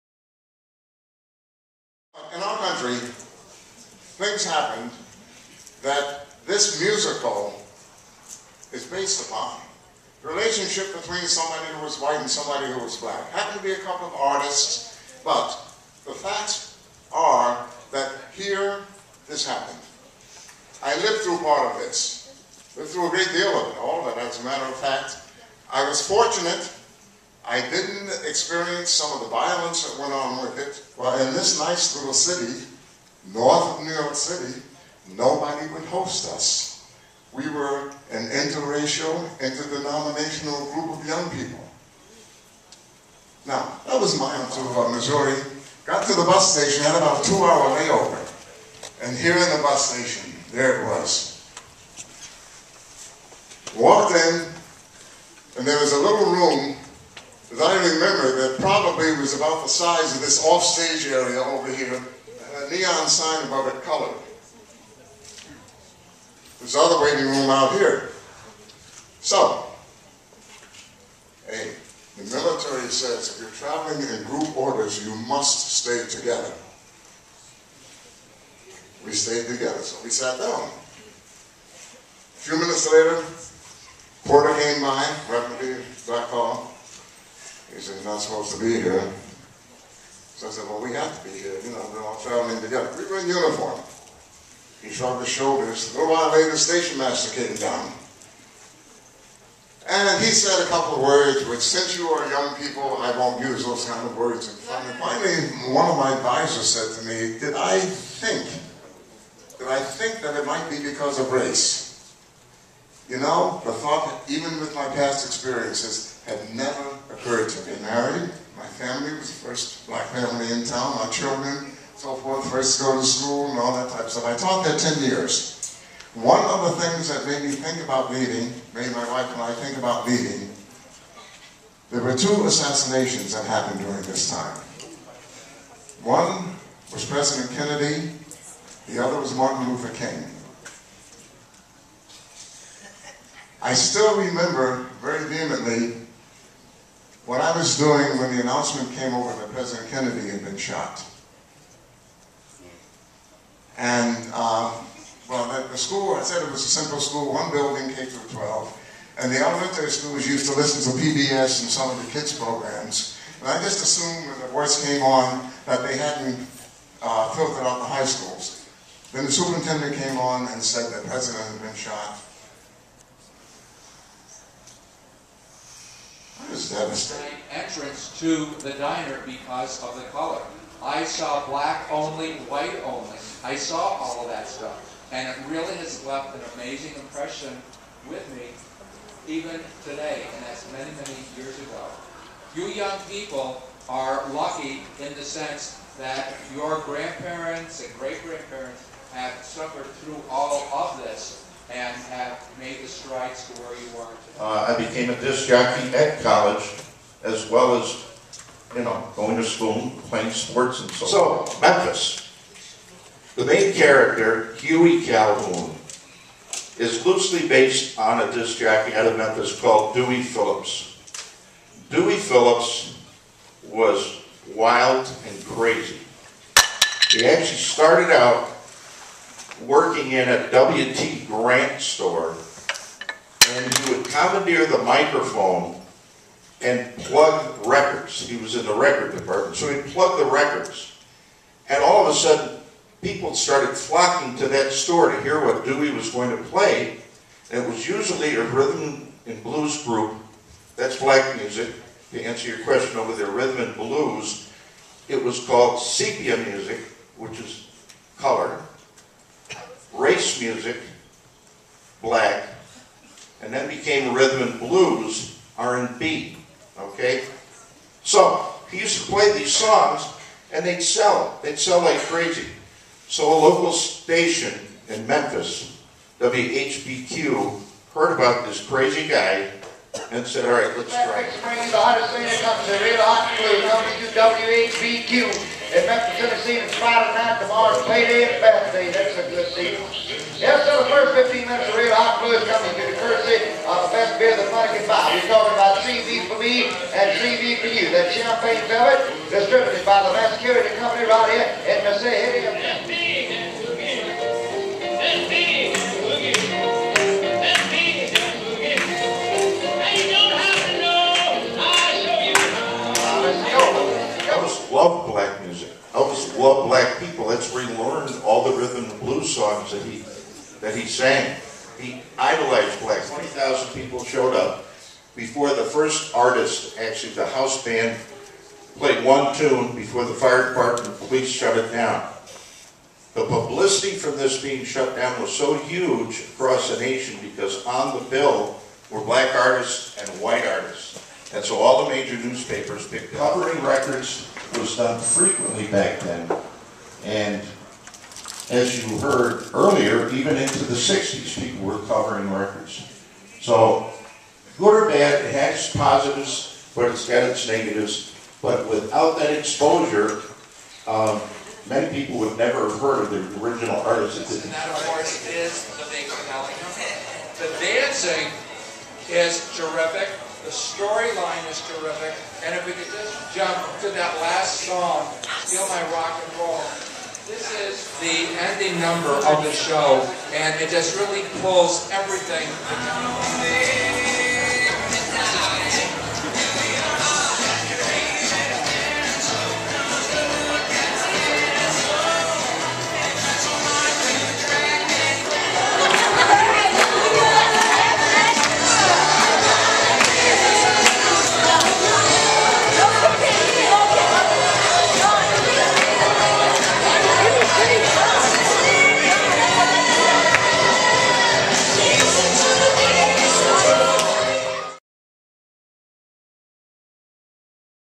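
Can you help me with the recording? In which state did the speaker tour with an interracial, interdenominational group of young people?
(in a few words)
Missouri.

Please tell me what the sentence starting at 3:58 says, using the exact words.
He was in the record department, so he'd plug the records.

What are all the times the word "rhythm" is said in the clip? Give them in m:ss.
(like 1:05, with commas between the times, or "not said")
4:08, 4:13, 4:24, 5:18.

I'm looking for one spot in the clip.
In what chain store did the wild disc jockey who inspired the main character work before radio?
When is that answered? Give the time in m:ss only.
3:50.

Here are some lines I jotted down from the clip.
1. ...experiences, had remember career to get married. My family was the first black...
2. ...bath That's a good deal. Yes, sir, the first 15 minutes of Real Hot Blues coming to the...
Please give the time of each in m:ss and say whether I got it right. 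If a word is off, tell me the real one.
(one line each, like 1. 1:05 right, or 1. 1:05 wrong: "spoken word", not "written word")
1. 1:55 wrong: "never", not "remember"
2. 4:48 right.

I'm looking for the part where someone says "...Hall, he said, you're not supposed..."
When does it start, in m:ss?
1:26.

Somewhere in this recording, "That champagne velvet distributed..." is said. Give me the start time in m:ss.
4:57.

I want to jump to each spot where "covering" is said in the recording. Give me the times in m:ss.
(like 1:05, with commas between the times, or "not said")
5:43, 5:51.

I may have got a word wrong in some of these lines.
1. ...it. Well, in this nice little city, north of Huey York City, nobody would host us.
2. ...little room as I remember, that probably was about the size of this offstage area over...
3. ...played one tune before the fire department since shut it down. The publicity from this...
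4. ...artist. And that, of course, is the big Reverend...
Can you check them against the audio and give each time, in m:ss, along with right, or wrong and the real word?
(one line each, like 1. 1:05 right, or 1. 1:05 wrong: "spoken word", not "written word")
1. 0:30 wrong: "New", not "Huey"
2. 0:55 right
3. 5:28 wrong: "police", not "since"
4. 6:03 wrong: "The", not "Reverend".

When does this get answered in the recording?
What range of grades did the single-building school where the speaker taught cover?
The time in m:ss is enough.
2:37.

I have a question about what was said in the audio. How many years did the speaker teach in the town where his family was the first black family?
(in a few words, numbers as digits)
10.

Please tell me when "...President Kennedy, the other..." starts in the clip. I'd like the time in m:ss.
2:17.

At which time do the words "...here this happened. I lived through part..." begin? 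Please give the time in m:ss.
0:18.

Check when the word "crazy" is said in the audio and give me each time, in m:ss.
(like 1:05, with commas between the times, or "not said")
3:45, 4:32, 4:38.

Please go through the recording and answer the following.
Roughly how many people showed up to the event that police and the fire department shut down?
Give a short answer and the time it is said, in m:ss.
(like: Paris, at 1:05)
20,000, at 5:23.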